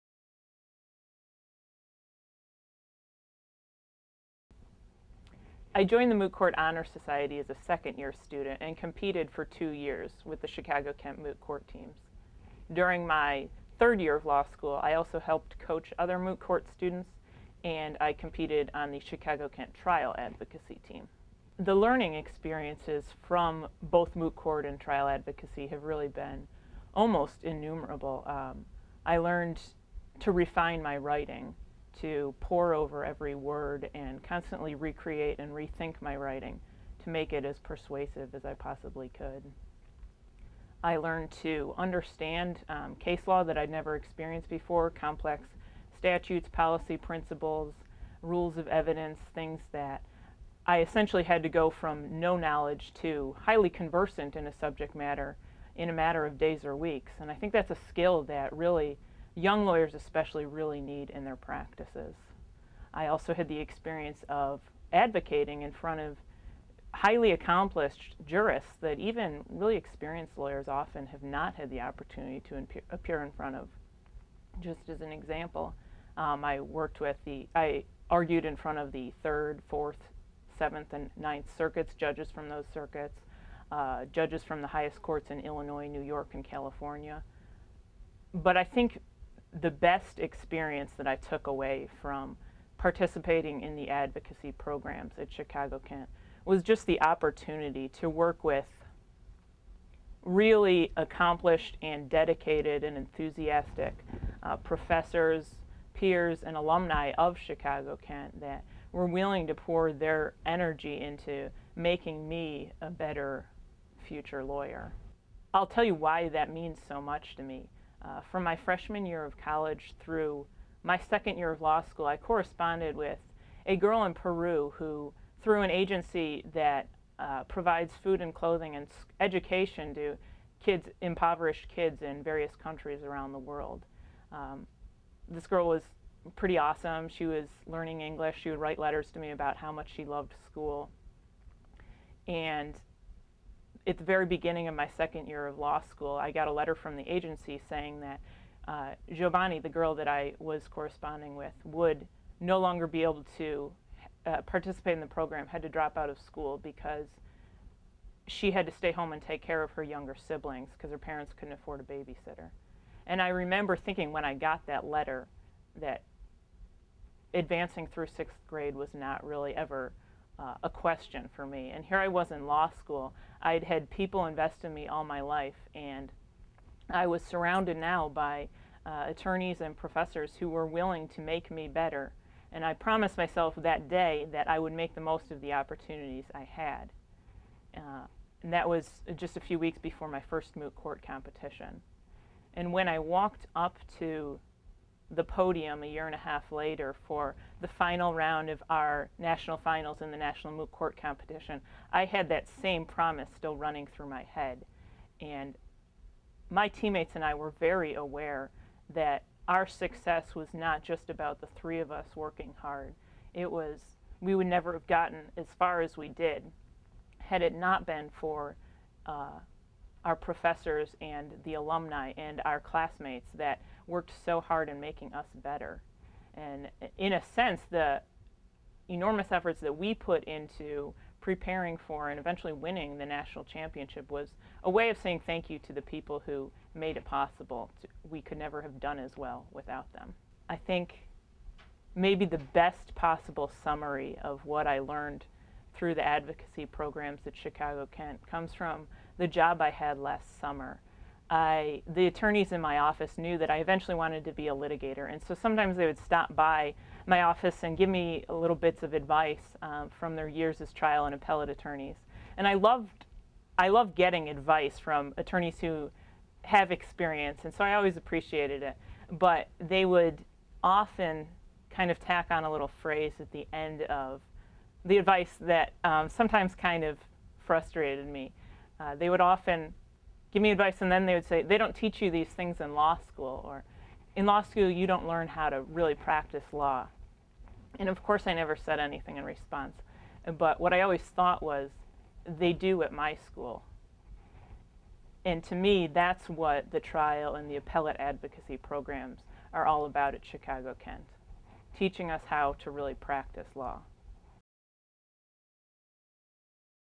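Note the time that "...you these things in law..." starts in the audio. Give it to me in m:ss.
4:42.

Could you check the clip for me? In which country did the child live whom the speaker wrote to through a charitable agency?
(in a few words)
Peru.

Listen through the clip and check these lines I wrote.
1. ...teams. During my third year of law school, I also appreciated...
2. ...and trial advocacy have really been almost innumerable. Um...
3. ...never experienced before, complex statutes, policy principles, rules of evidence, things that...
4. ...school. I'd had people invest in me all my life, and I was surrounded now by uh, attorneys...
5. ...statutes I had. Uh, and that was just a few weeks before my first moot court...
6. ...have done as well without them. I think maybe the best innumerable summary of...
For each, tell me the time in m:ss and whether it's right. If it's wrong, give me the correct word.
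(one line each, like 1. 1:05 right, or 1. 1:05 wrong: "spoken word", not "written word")
1. 0:11 wrong: "helped", not "appreciated"
2. 0:24 right
3. 0:43 right
4. 2:52 right
5. 3:05 wrong: "opportunities", not "statutes"
6. 3:58 wrong: "possible", not "innumerable".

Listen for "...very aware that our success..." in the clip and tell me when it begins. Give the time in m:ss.
3:27.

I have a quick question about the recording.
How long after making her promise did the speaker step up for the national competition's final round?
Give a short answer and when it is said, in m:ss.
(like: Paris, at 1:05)
a year and a half, at 3:15.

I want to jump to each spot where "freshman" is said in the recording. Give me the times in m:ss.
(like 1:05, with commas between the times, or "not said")
1:58.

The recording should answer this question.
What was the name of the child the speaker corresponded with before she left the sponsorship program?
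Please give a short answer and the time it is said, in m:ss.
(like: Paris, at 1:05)
Giovanni, at 2:29.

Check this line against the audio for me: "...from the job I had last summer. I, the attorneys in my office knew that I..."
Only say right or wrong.
right.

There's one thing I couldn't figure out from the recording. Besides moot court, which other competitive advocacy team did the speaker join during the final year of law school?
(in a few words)
Trial Advocacy team.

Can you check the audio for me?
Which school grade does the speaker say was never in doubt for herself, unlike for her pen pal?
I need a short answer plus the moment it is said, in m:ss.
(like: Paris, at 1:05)
sixth grade, at 2:48.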